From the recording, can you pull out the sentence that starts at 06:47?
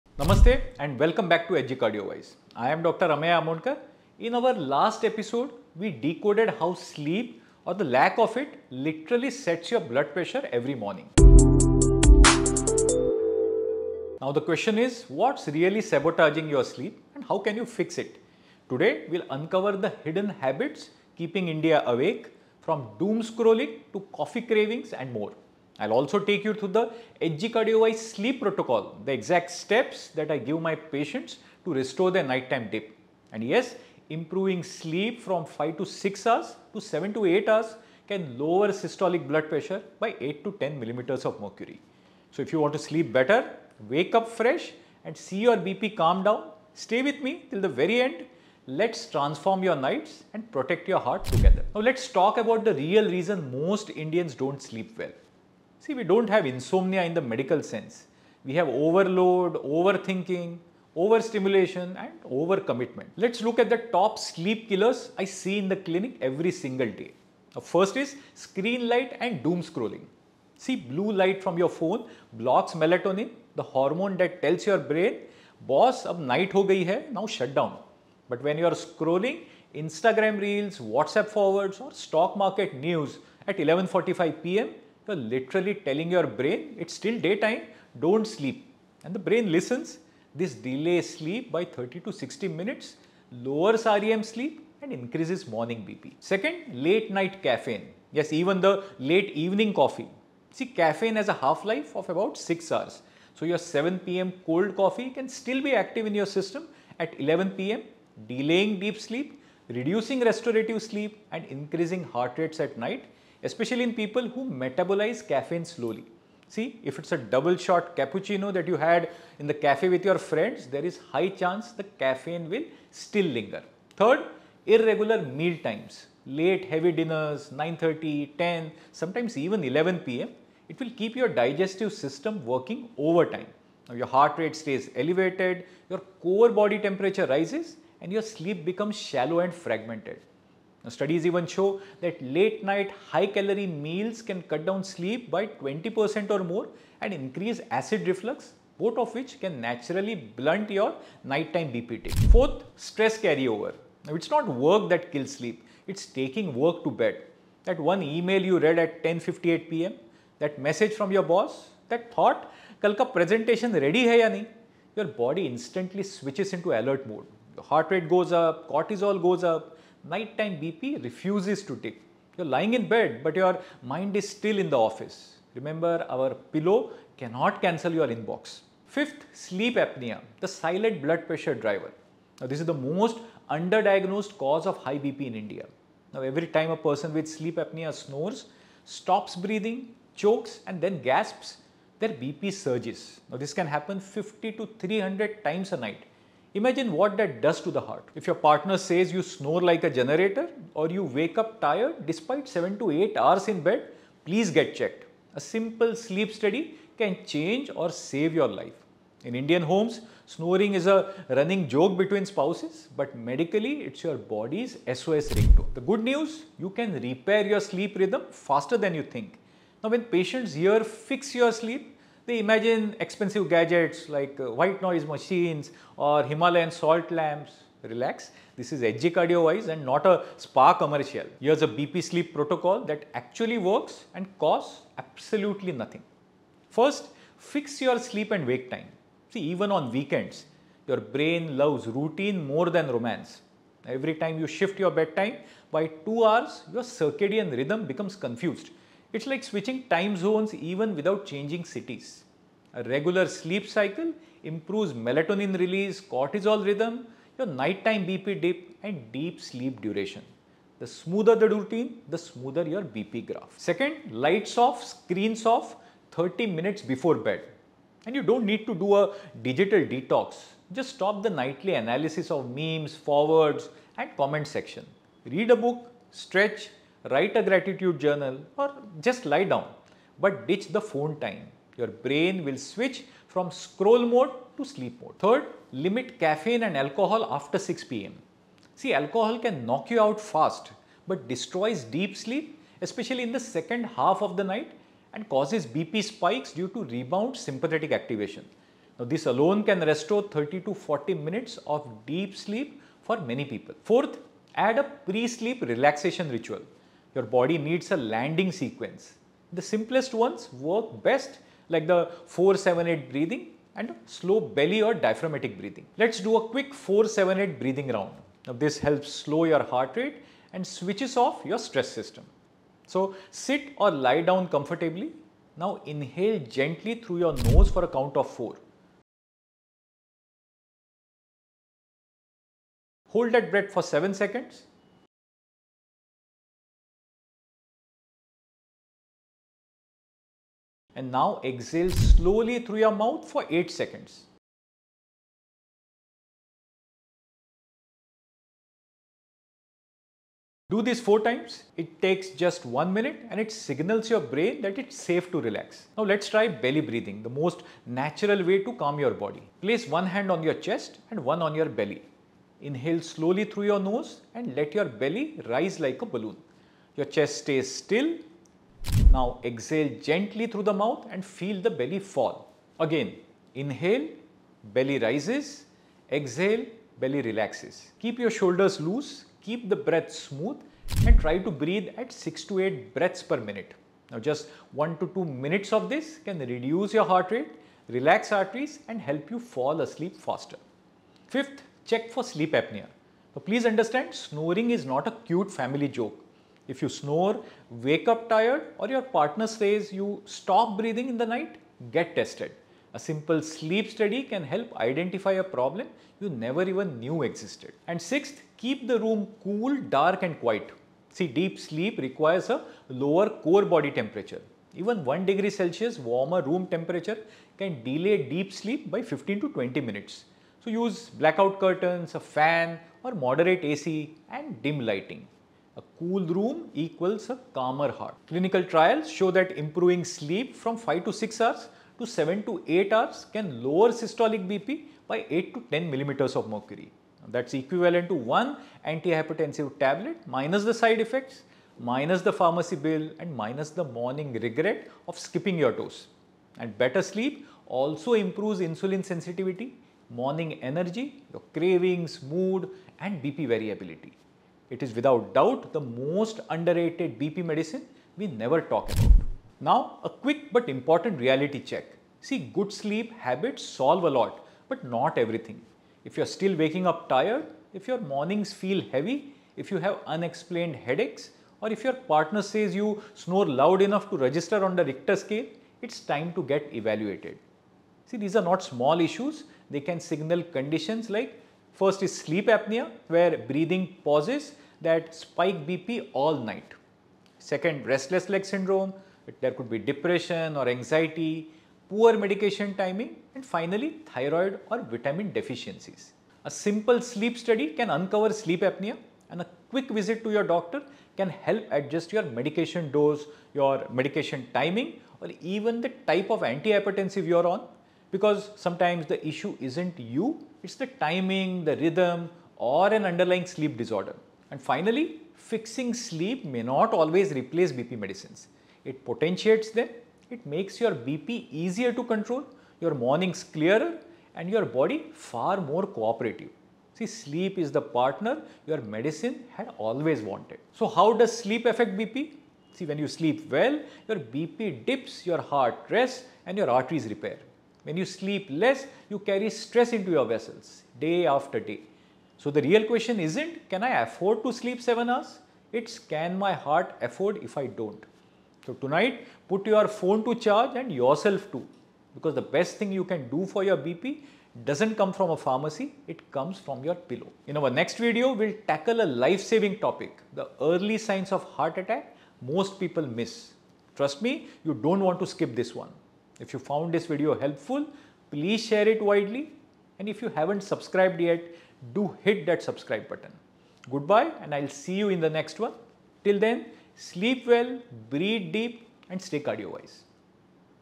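And sixth, keep the room cool, dark and quiet.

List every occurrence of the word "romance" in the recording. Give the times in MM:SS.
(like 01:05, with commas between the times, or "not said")
04:02.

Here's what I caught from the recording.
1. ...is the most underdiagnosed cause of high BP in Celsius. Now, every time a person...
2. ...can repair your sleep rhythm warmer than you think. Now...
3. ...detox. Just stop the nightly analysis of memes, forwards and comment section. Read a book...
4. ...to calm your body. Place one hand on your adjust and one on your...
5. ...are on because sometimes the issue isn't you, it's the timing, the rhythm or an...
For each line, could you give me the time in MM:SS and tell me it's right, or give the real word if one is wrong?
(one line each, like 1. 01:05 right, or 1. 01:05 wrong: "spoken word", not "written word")
1. 03:02 wrong: "India", not "Celsius"
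2. 03:36 wrong: "faster", not "warmer"
3. 04:29 right
4. 05:58 wrong: "chest", not "adjust"
5. 08:27 right.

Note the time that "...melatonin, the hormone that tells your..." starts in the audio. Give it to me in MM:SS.
01:12.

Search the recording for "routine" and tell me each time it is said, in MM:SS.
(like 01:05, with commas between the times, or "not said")
04:01, 04:21.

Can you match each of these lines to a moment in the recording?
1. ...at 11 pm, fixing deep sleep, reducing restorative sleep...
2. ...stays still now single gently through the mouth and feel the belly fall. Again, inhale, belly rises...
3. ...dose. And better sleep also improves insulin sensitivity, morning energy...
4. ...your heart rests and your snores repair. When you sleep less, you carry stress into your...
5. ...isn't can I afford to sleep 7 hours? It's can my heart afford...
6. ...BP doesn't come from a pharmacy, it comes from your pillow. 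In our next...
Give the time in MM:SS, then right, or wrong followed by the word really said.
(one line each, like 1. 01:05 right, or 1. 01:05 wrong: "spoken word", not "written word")
1. 01:46 wrong: "delaying", not "fixing"
2. 06:07 wrong: "exhale", not "single"
3. 07:25 right
4. 08:55 wrong: "arteries", not "snores"
5. 09:03 right
6. 09:13 right.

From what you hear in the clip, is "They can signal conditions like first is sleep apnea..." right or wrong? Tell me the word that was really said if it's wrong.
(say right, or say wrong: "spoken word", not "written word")
right.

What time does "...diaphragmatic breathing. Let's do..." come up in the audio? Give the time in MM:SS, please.
05:14.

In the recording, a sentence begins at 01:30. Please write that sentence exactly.
This delays sleep by 30 to 60 minutes, lowers REM sleep and increases morning BP.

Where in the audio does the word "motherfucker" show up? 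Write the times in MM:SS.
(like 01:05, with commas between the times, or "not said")
not said.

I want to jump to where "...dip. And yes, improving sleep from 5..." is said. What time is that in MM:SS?
00:32.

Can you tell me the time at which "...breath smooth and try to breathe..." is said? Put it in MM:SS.
06:19.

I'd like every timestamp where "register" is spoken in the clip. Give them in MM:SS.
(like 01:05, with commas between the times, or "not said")
07:54.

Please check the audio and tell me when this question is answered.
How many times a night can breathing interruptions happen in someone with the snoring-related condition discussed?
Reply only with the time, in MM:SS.
03:13.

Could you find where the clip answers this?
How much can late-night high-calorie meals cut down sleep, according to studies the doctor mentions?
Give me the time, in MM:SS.
02:25.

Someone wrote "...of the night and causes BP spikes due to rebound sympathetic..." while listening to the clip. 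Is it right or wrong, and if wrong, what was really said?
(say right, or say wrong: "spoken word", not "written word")
right.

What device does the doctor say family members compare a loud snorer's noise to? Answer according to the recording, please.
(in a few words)
A generator.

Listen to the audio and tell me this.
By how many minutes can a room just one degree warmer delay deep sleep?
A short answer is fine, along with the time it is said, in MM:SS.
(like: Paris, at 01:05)
15 to 20 minutes, at 06:59.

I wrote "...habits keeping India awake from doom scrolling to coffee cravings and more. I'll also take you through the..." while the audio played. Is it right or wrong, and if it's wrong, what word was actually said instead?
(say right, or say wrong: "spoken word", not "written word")
right.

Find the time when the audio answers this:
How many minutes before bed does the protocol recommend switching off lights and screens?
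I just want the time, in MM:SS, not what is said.
04:26.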